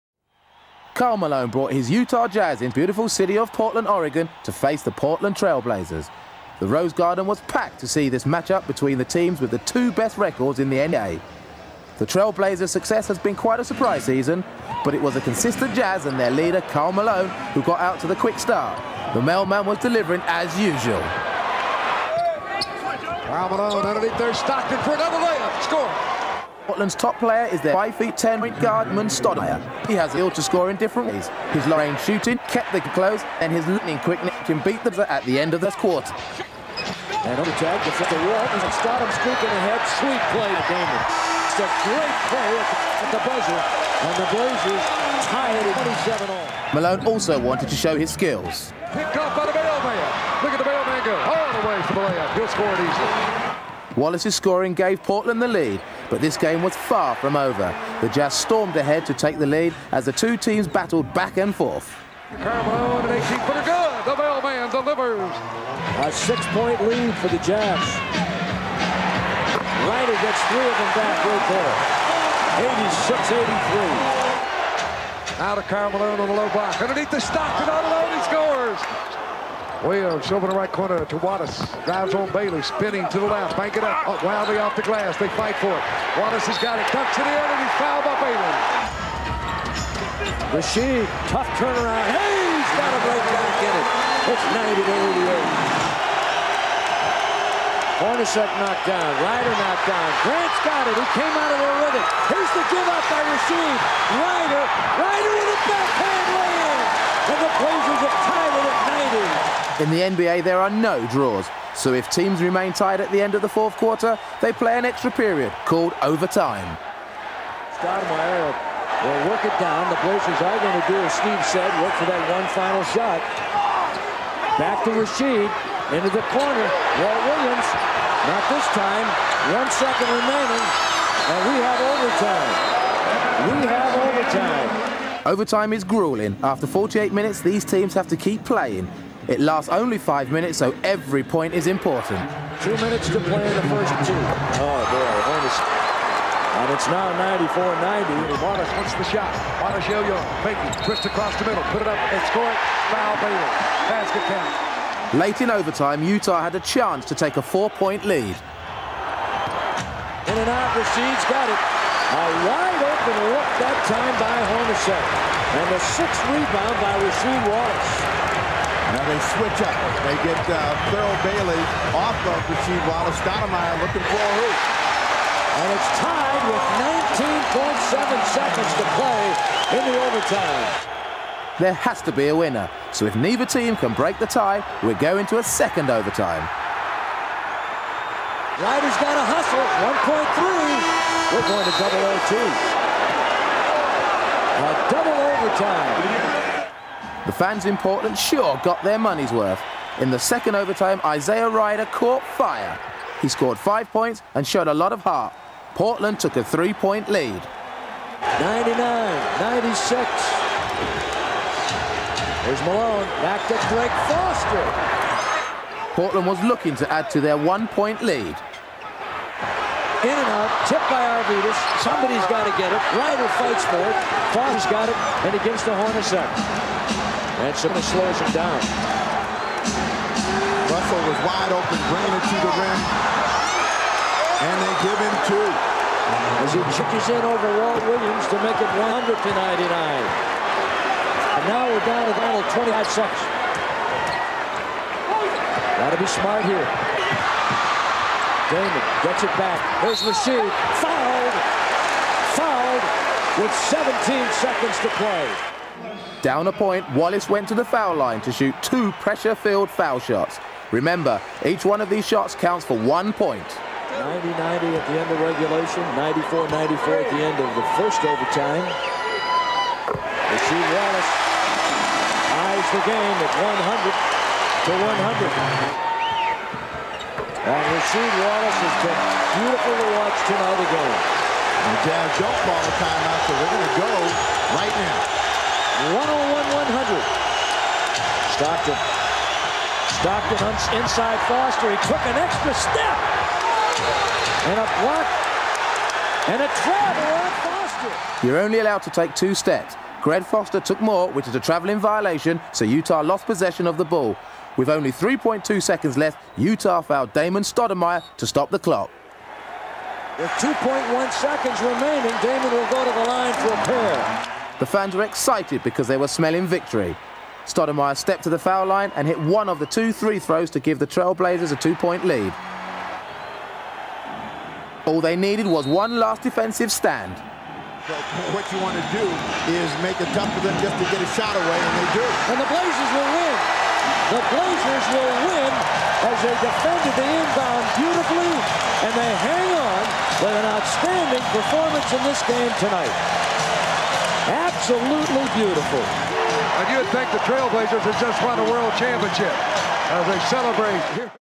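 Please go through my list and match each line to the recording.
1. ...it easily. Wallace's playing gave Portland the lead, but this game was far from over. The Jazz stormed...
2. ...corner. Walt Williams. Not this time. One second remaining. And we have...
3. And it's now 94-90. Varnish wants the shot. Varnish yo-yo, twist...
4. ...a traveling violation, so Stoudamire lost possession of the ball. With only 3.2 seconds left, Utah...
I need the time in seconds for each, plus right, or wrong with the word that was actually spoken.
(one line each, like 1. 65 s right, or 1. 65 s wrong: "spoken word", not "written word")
1. 52 s wrong: "scoring", not "playing"
2. 126 s right
3. 146 s right
4. 301 s wrong: "Utah", not "Stoudamire".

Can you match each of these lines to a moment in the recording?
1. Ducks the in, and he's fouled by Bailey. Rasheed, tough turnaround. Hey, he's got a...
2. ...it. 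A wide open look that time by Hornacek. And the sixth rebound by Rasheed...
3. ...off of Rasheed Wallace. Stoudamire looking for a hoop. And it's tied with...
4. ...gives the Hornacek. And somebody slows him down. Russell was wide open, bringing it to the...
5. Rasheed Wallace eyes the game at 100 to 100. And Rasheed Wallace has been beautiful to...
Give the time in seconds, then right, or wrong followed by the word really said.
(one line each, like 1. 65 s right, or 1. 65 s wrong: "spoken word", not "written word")
1. 86 s right
2. 161 s right
3. 171 s right
4. 225 s right
5. 270 s right.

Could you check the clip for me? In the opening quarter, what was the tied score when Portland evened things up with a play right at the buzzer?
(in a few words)
27.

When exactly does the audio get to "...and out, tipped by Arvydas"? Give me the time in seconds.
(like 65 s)
220 s.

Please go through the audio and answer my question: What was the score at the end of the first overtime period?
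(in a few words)
94-94.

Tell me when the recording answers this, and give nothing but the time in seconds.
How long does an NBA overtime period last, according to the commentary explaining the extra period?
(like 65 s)
139 s.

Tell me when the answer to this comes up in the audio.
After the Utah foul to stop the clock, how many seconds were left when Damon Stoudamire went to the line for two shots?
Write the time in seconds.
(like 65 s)
310 s.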